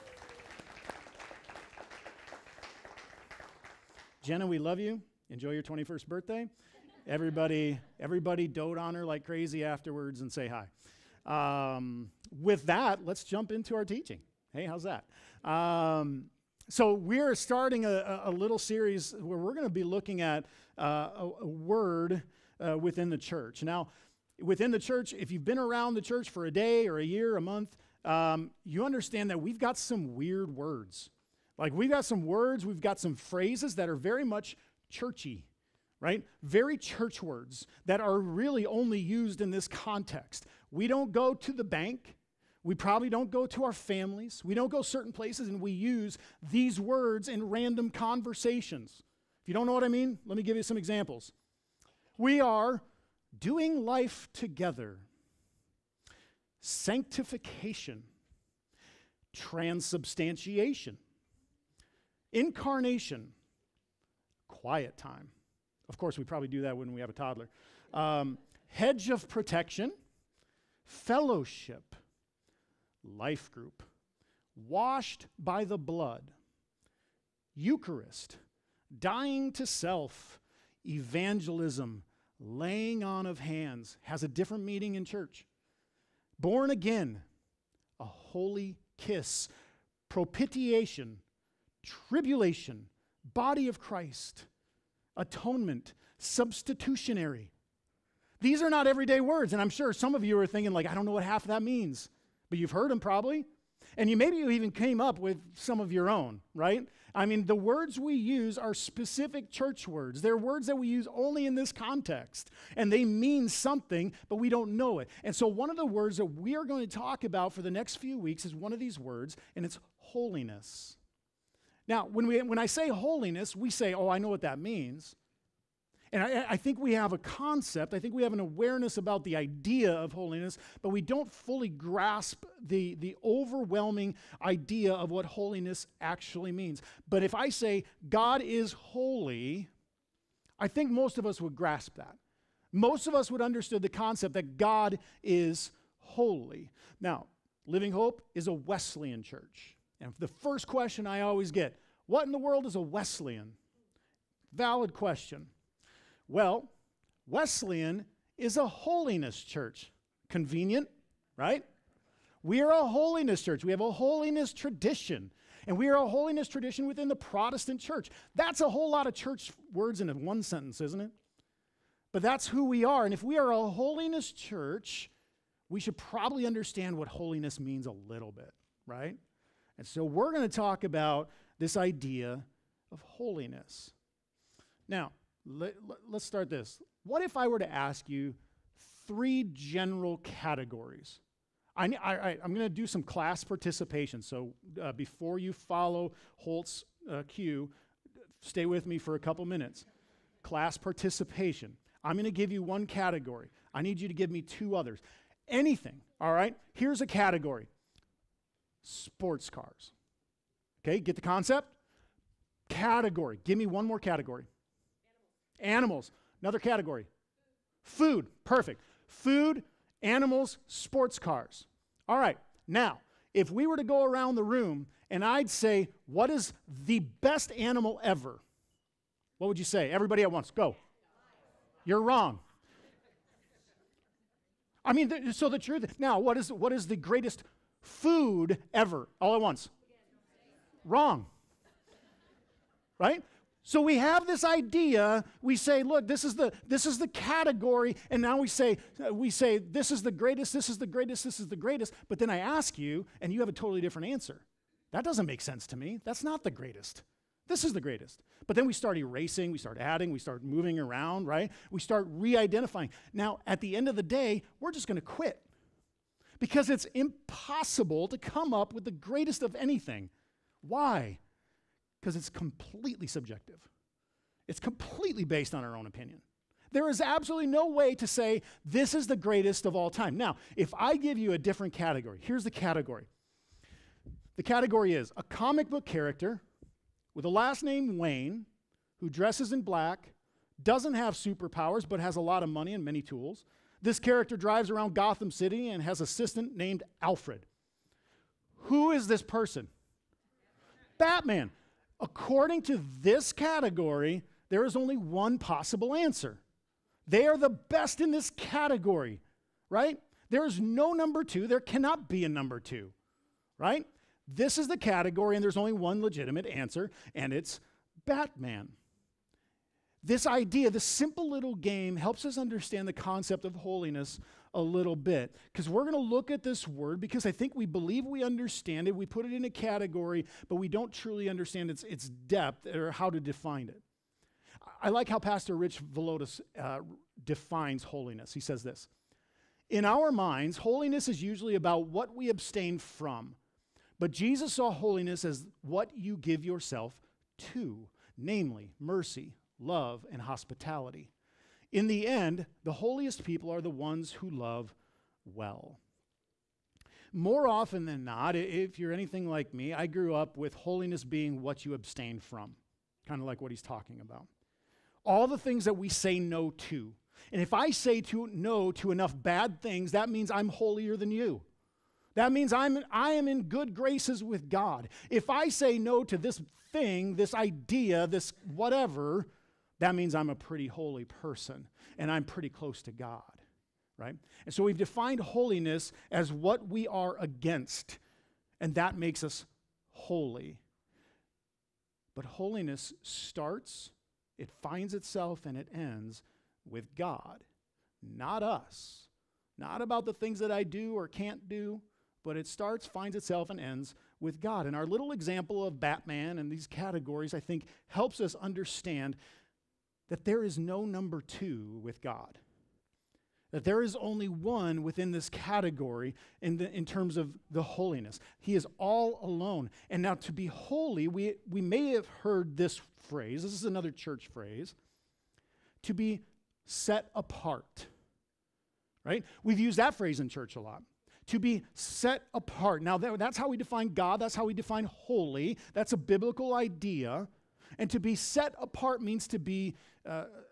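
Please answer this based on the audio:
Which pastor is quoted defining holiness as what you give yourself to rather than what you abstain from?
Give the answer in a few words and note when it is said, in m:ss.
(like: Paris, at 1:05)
Rich Villodas, at 5:35.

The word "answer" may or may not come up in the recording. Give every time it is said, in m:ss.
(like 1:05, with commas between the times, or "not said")
4:14, 5:05, 5:16.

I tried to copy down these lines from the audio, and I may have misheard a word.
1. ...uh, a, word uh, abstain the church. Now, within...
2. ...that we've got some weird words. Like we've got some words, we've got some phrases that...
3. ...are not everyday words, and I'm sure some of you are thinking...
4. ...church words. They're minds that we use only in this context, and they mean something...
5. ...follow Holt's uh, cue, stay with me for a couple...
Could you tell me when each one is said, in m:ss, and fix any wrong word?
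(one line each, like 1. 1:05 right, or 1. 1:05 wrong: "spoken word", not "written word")
1. 0:20 wrong: "within", not "abstain"
2. 0:29 right
3. 1:38 right
4. 1:49 wrong: "words", not "minds"
5. 3:15 right.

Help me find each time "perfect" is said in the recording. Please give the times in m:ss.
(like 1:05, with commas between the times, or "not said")
3:38.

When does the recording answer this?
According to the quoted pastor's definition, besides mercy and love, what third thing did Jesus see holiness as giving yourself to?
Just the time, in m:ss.
5:50.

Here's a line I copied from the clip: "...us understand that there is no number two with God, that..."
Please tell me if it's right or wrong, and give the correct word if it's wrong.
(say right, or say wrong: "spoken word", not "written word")
right.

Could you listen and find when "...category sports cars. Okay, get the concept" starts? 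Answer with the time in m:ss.
3:27.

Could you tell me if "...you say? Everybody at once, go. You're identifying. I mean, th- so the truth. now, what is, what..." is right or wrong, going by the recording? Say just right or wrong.
wrong.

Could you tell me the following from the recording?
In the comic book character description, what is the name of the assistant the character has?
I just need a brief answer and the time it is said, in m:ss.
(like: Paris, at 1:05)
Alfred, at 4:57.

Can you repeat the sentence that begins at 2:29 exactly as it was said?
And the first question I always get, what in the world is a Wesleyan?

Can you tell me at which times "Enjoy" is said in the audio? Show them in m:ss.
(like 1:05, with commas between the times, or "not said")
0:05.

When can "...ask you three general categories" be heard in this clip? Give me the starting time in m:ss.
3:07.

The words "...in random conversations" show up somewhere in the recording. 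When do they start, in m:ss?
0:47.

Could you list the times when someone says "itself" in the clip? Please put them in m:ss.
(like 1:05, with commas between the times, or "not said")
6:34, 6:43.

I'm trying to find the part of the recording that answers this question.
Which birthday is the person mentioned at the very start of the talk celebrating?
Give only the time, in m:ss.
0:05.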